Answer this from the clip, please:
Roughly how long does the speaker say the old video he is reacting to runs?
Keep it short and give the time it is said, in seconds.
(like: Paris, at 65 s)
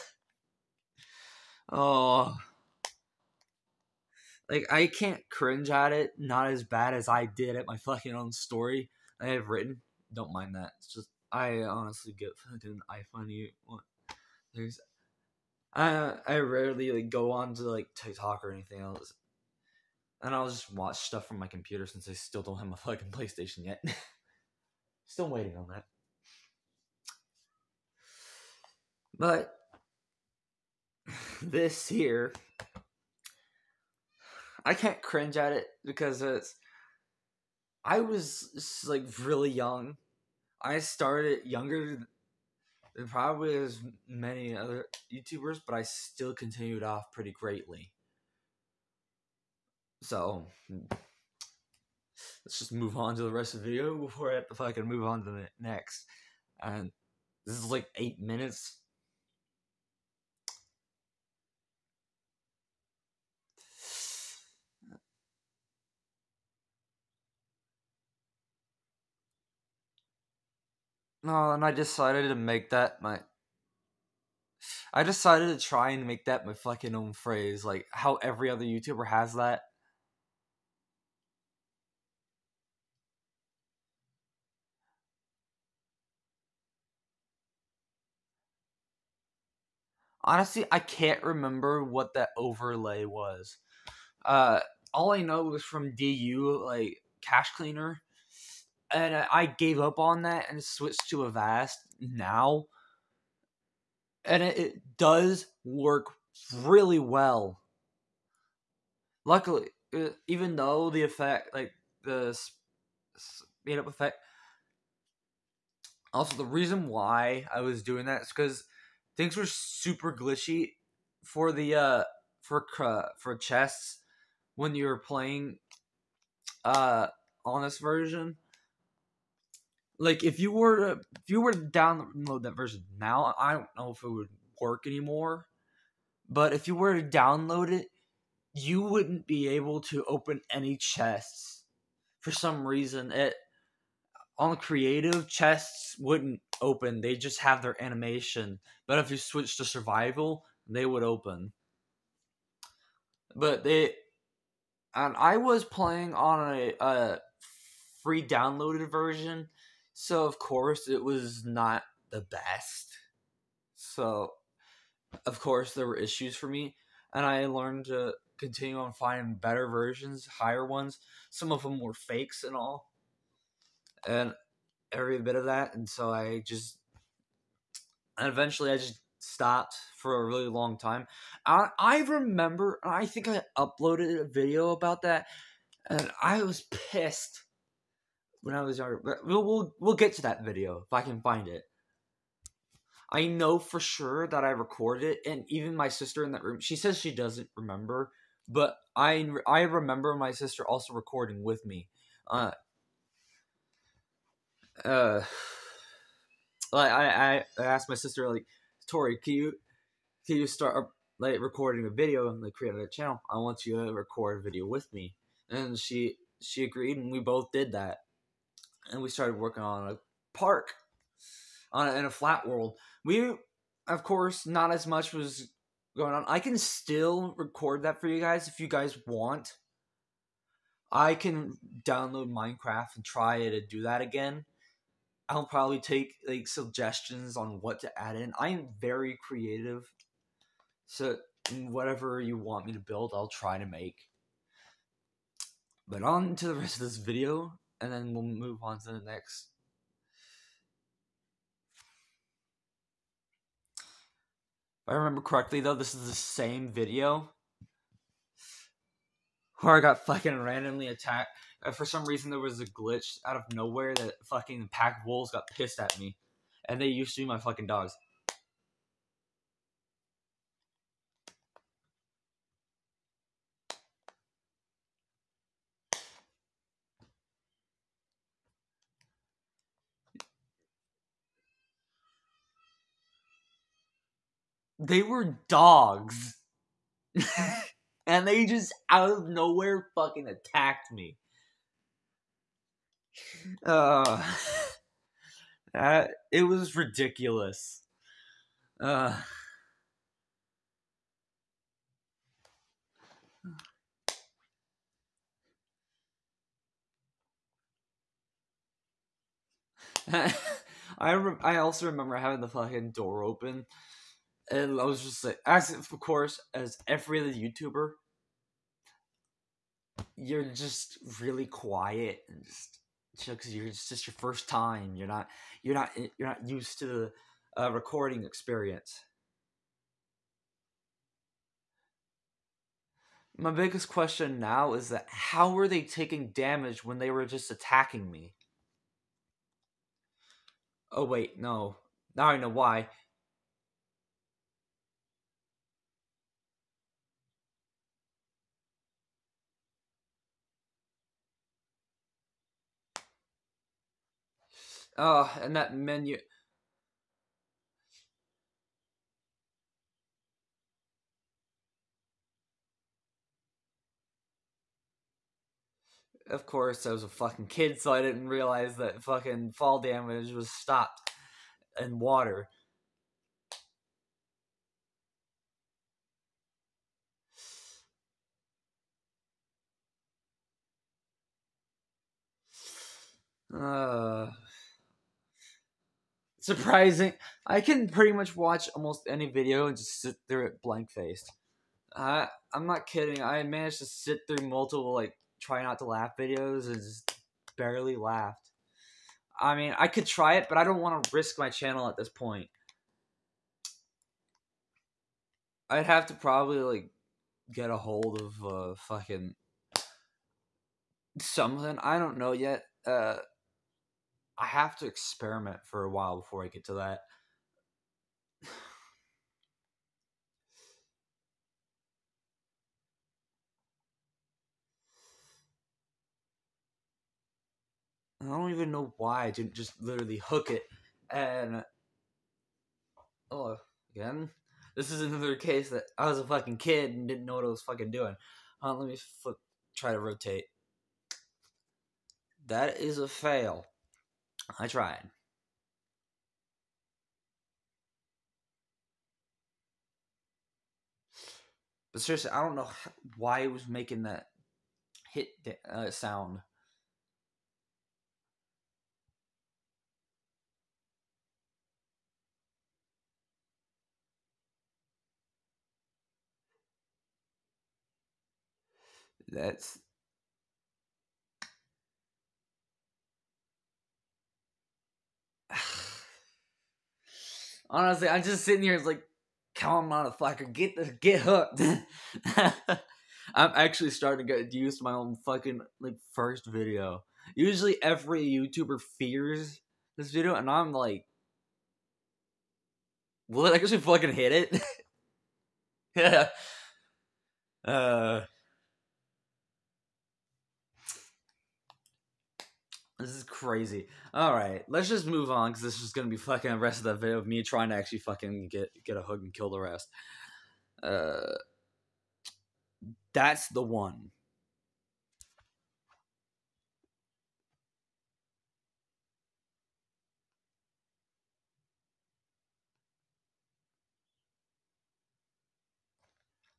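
8 minutes, at 57 s.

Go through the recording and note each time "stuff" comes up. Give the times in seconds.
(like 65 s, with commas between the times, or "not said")
20 s.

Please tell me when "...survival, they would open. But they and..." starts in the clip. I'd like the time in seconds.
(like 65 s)
149 s.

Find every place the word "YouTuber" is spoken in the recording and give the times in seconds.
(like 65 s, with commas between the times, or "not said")
45 s, 78 s, 317 s, 488 s.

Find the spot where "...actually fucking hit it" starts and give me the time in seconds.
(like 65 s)
493 s.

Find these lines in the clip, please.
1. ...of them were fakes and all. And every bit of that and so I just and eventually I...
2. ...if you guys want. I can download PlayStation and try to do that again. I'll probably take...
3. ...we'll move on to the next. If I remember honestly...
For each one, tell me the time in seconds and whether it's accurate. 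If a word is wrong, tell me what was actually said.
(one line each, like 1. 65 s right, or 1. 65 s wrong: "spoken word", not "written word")
1. 171 s right
2. 228 s wrong: "Minecraft", not "PlayStation"
3. 248 s wrong: "correctly", not "honestly".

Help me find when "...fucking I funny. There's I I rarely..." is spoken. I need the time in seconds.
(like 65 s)
12 s.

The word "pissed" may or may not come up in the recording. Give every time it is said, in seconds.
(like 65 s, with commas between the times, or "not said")
186 s, 265 s.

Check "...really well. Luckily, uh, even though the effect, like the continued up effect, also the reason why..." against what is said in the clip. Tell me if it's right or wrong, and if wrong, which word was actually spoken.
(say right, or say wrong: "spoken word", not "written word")
wrong: "speed", not "continued".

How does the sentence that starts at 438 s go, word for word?
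Uh, let me flip, try to rotate.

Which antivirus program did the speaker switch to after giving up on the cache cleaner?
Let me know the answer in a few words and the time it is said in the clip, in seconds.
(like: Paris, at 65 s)
Avast, at 101 s.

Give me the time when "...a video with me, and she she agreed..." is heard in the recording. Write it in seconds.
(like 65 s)
214 s.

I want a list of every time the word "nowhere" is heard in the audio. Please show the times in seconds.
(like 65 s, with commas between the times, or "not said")
263 s, 289 s.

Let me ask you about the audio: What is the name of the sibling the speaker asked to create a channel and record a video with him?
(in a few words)
Tori.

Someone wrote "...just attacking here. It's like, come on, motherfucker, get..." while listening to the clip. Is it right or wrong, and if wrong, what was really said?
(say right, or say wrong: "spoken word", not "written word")
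wrong: "sitting", not "attacking".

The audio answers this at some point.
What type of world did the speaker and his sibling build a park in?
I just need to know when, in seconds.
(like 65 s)
222 s.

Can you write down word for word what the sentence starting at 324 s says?
You're not you're not eh, you're not used to the uh, recording experience.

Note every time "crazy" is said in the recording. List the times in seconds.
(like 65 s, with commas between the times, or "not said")
503 s.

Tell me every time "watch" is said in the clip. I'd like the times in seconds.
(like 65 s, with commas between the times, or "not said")
20 s, 388 s.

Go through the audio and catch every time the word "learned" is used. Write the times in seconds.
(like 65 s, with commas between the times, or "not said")
167 s.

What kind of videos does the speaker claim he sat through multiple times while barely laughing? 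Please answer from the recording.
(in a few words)
Try not to laugh videos.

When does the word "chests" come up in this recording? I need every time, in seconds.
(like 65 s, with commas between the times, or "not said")
123 s, 140 s, 145 s.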